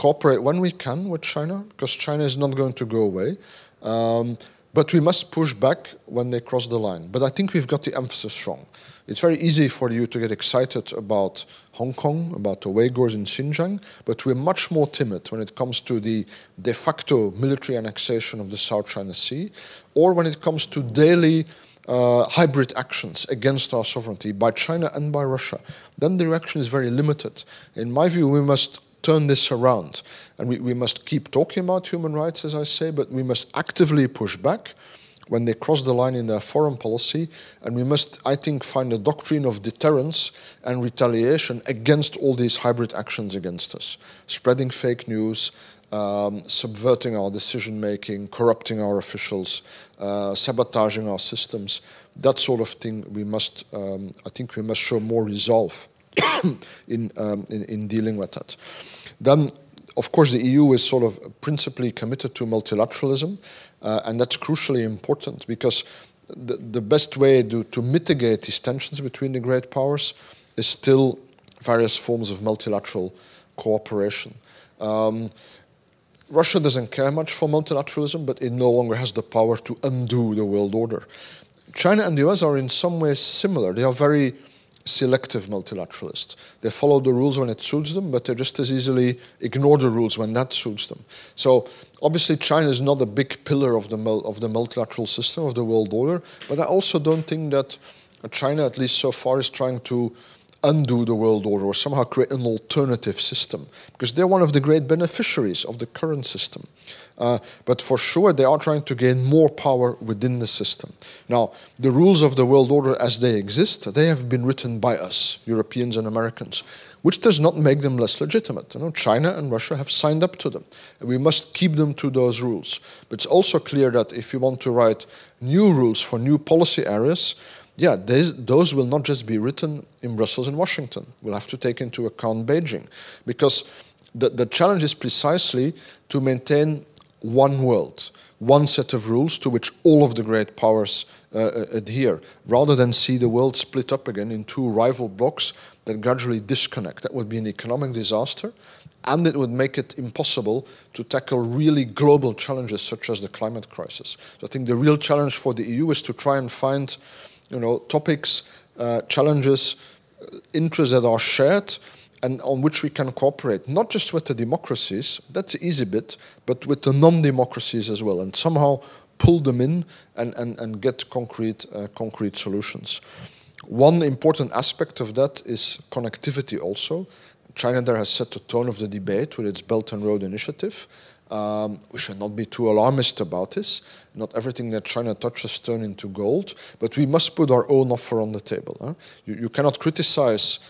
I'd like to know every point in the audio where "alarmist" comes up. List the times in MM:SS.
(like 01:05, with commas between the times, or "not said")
03:02.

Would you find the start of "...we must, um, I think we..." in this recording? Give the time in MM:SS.
00:53.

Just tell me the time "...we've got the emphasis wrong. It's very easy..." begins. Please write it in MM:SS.
00:07.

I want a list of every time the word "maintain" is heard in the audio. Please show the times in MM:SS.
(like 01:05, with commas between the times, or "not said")
02:16.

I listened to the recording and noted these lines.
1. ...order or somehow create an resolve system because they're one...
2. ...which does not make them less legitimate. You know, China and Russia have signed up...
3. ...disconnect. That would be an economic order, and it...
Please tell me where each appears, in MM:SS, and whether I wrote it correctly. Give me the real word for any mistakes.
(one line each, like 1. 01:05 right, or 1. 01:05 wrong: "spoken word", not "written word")
1. 01:41 wrong: "alternative", not "resolve"
2. 01:57 right
3. 02:26 wrong: "disaster", not "order".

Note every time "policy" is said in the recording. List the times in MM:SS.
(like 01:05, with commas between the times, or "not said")
00:36, 02:06.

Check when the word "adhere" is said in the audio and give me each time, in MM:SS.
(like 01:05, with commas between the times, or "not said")
02:21.